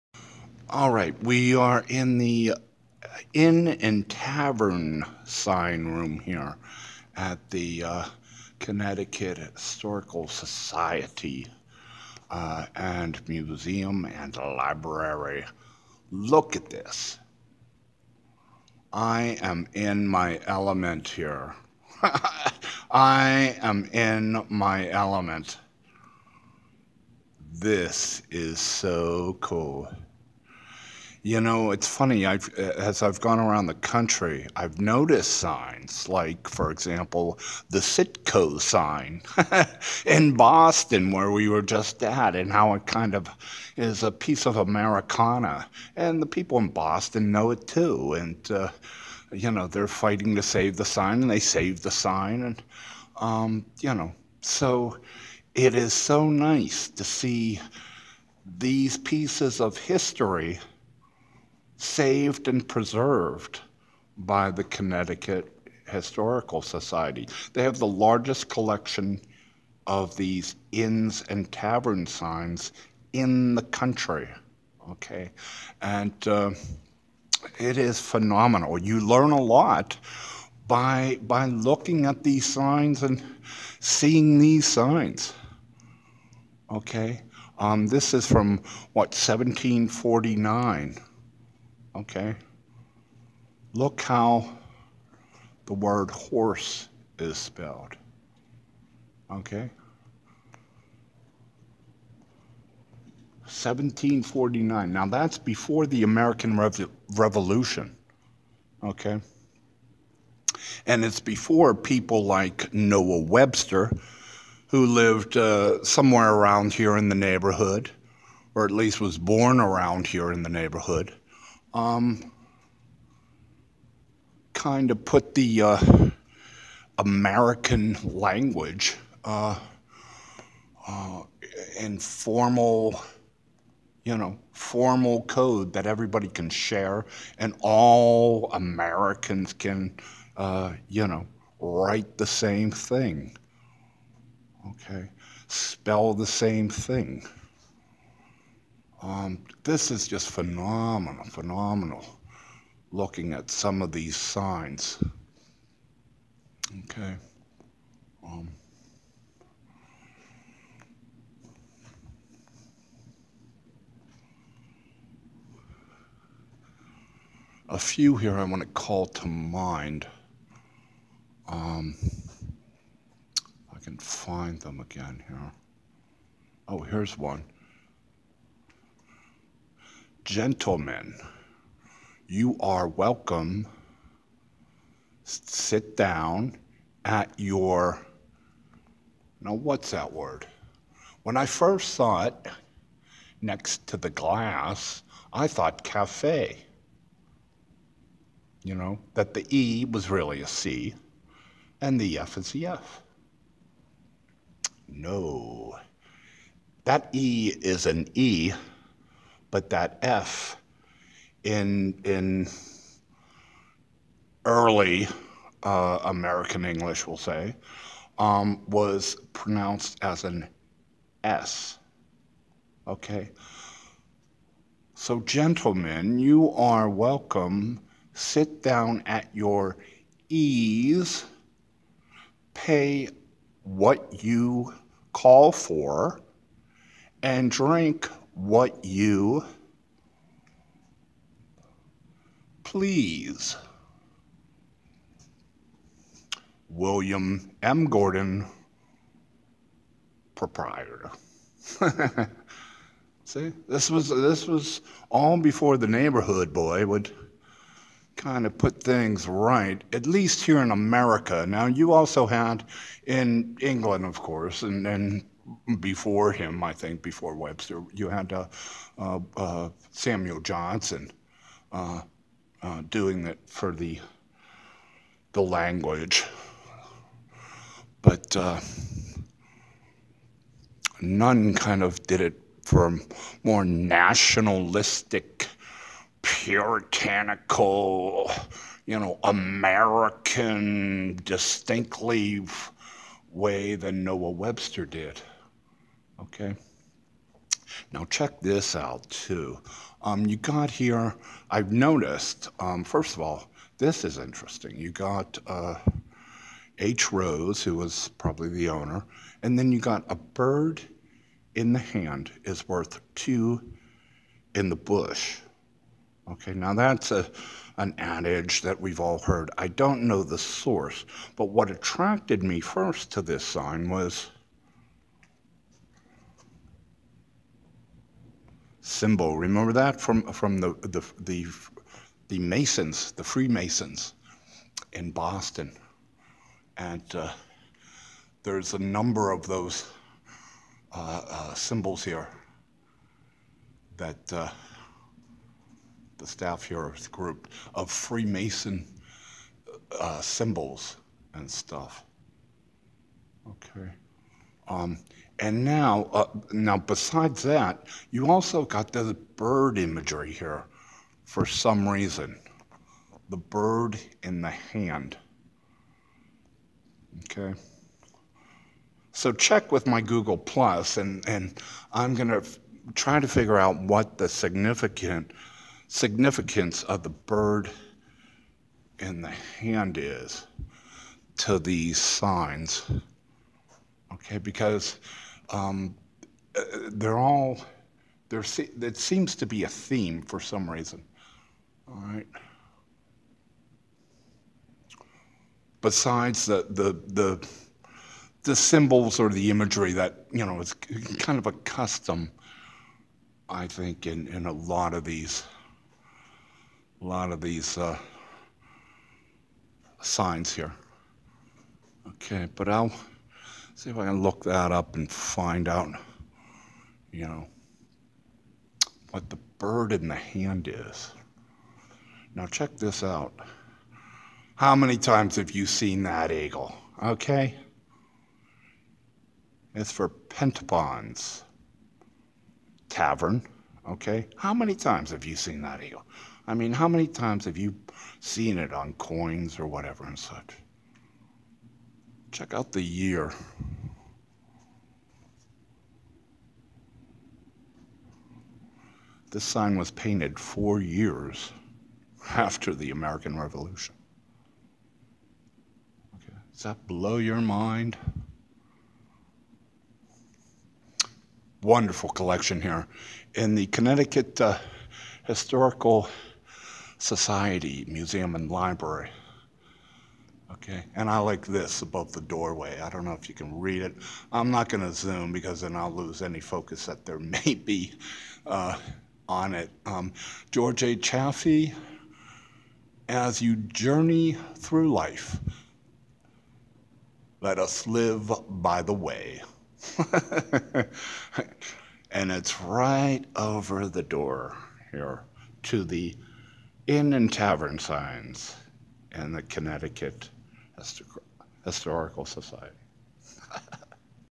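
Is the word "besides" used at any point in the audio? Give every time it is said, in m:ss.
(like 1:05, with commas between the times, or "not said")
5:56, 6:35.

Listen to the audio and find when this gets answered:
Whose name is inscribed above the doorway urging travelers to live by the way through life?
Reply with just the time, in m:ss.
8:00.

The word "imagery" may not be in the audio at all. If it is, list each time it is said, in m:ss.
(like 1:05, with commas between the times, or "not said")
5:59, 6:39.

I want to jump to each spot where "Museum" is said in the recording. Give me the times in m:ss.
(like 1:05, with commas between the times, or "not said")
0:13, 7:47.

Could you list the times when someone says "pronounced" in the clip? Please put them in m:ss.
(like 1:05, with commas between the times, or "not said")
3:39.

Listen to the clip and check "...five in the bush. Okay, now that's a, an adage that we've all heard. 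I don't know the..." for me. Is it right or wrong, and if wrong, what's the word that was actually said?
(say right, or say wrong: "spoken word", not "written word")
wrong: "two", not "five".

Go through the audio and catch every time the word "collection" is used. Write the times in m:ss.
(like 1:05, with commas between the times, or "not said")
1:08, 7:42.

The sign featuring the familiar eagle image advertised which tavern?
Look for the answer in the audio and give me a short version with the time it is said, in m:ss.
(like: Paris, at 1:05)
Pettibone's Tavern, at 7:10.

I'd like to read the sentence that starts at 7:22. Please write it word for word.
Check out the year This sign was painted four years after the American Revolution.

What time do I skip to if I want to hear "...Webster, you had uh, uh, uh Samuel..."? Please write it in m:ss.
4:27.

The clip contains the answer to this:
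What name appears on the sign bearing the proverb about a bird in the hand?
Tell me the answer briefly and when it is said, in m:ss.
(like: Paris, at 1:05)
H. Rose, at 5:06.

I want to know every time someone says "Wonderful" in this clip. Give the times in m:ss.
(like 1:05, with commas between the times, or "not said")
7:41.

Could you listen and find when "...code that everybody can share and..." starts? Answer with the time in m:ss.
2:15.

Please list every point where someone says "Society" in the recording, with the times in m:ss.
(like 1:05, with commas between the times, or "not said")
0:10, 1:06, 7:46, 8:22.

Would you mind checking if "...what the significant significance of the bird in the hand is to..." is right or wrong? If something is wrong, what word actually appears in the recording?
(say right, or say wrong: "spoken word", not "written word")
right.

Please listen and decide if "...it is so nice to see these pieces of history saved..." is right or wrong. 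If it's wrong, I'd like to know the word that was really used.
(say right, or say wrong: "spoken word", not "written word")
right.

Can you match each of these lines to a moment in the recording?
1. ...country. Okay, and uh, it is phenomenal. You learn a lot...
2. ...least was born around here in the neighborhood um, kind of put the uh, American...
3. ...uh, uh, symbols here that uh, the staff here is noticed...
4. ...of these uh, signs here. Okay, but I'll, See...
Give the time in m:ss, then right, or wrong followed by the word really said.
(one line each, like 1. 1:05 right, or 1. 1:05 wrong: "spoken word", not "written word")
1. 1:13 right
2. 1:58 right
3. 5:40 wrong: "grouped", not "noticed"
4. 6:47 right.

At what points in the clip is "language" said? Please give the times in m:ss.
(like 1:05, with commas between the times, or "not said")
2:08, 4:35.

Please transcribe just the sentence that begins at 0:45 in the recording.
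And the people in Boston know it too.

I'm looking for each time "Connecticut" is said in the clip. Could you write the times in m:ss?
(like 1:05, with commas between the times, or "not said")
0:08, 1:04, 7:43, 8:19.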